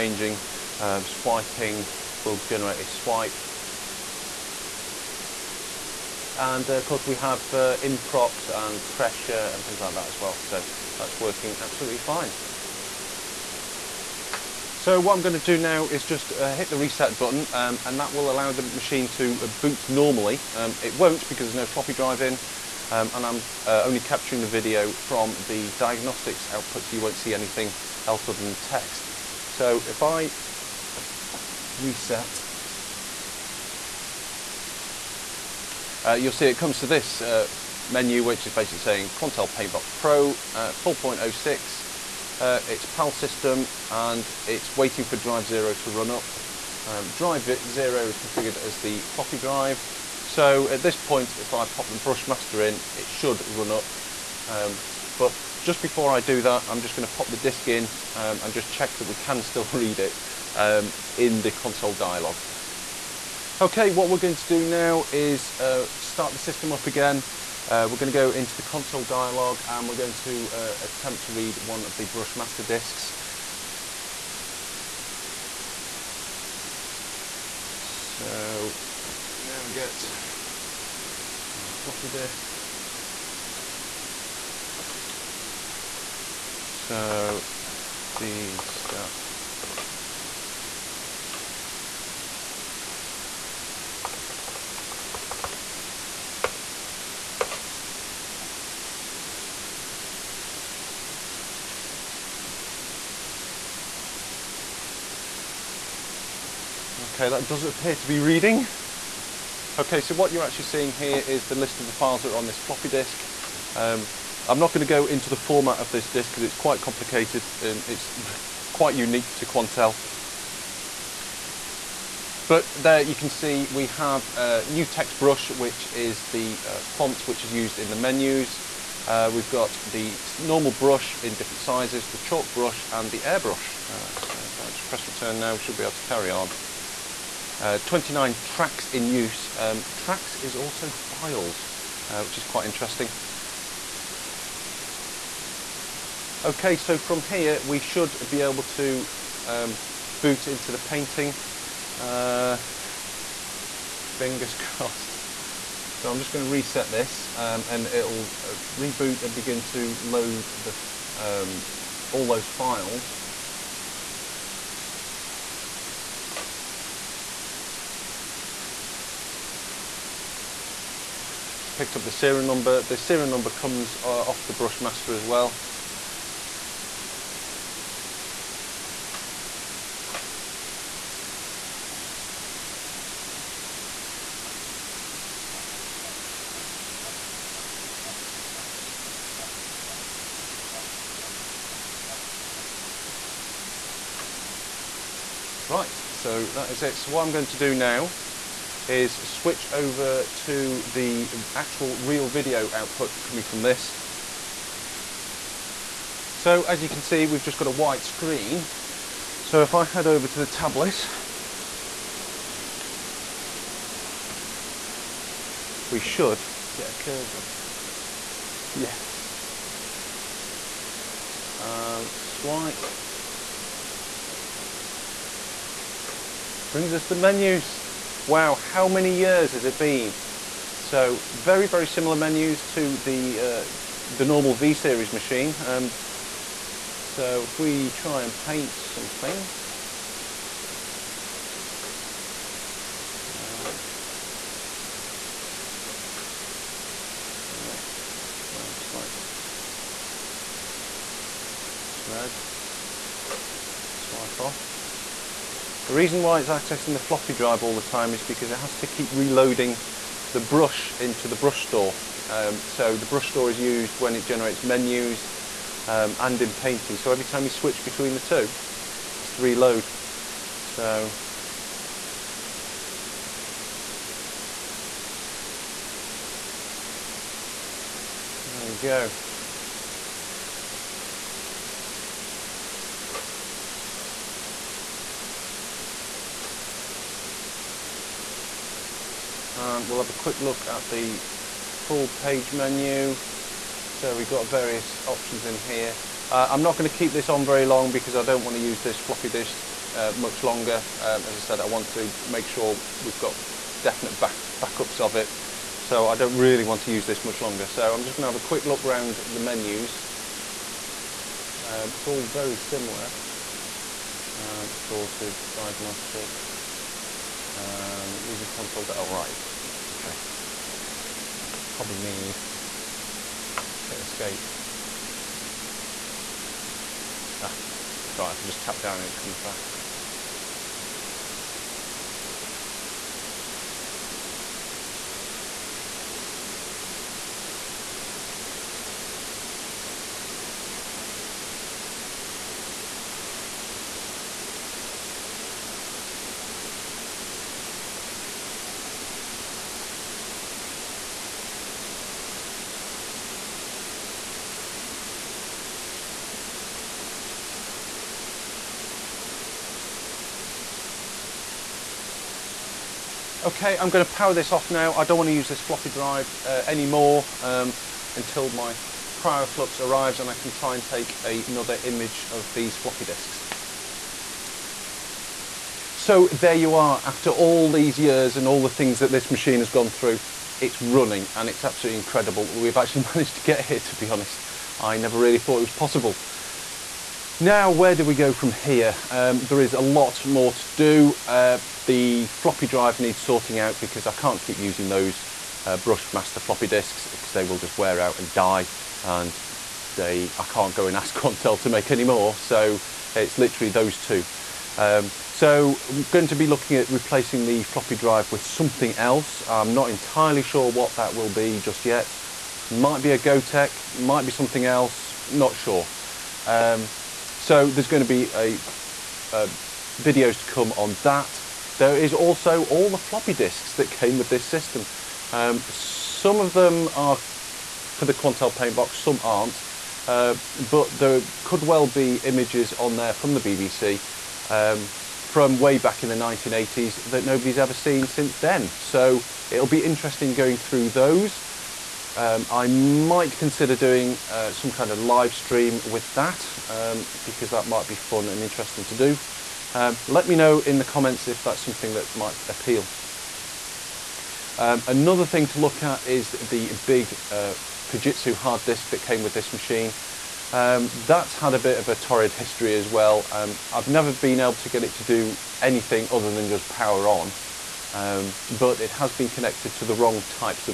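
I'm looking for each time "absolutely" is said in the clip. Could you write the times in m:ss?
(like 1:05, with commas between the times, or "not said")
0:11, 6:21.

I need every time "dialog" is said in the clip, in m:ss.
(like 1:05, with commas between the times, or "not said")
1:01, 1:09.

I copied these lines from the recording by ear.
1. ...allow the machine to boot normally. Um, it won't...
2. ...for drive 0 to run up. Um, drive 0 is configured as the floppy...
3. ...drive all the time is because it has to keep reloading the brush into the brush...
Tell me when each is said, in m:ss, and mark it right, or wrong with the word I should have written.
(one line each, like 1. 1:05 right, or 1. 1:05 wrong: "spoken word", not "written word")
1. 0:18 right
2. 0:45 right
3. 4:17 right.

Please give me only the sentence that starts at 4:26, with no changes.
So every time you switch between the two, it has to reload.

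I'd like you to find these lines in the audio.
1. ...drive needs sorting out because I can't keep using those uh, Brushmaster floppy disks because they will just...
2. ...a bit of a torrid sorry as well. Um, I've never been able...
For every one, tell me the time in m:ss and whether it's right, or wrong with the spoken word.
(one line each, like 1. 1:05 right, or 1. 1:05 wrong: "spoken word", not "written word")
1. 6:32 right
2. 7:41 wrong: "history", not "sorry".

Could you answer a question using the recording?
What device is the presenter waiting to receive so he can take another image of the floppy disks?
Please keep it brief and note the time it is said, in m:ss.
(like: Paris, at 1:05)
KryoFlux, at 6:09.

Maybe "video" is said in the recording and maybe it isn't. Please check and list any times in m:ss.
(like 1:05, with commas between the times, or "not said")
0:24, 3:22, 7:00.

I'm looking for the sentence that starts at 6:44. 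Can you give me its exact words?
Um, so I'm going to be looking at replacing the floppy drive with something else.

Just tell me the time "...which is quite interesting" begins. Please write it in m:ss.
2:22.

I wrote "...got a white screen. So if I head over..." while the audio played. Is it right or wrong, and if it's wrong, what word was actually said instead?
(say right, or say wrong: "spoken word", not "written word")
right.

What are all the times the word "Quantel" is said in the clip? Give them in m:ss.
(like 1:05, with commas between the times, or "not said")
0:39, 1:59, 6:41, 7:08.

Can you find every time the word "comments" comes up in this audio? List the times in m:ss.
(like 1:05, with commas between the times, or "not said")
7:30.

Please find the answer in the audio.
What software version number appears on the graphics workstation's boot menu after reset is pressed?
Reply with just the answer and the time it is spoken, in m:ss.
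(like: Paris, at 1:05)
4.06, at 0:40.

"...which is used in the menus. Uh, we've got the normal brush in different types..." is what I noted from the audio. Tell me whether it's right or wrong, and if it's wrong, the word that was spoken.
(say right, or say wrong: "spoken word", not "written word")
wrong: "sizes", not "types".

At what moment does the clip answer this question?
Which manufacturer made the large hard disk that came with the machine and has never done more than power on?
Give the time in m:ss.
7:37.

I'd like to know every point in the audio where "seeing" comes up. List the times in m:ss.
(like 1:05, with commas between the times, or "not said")
1:50.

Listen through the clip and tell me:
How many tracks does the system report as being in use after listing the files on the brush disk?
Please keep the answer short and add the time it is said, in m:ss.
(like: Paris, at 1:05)
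29, at 2:17.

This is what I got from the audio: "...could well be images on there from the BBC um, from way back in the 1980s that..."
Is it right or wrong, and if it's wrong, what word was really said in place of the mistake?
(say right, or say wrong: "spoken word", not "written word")
right.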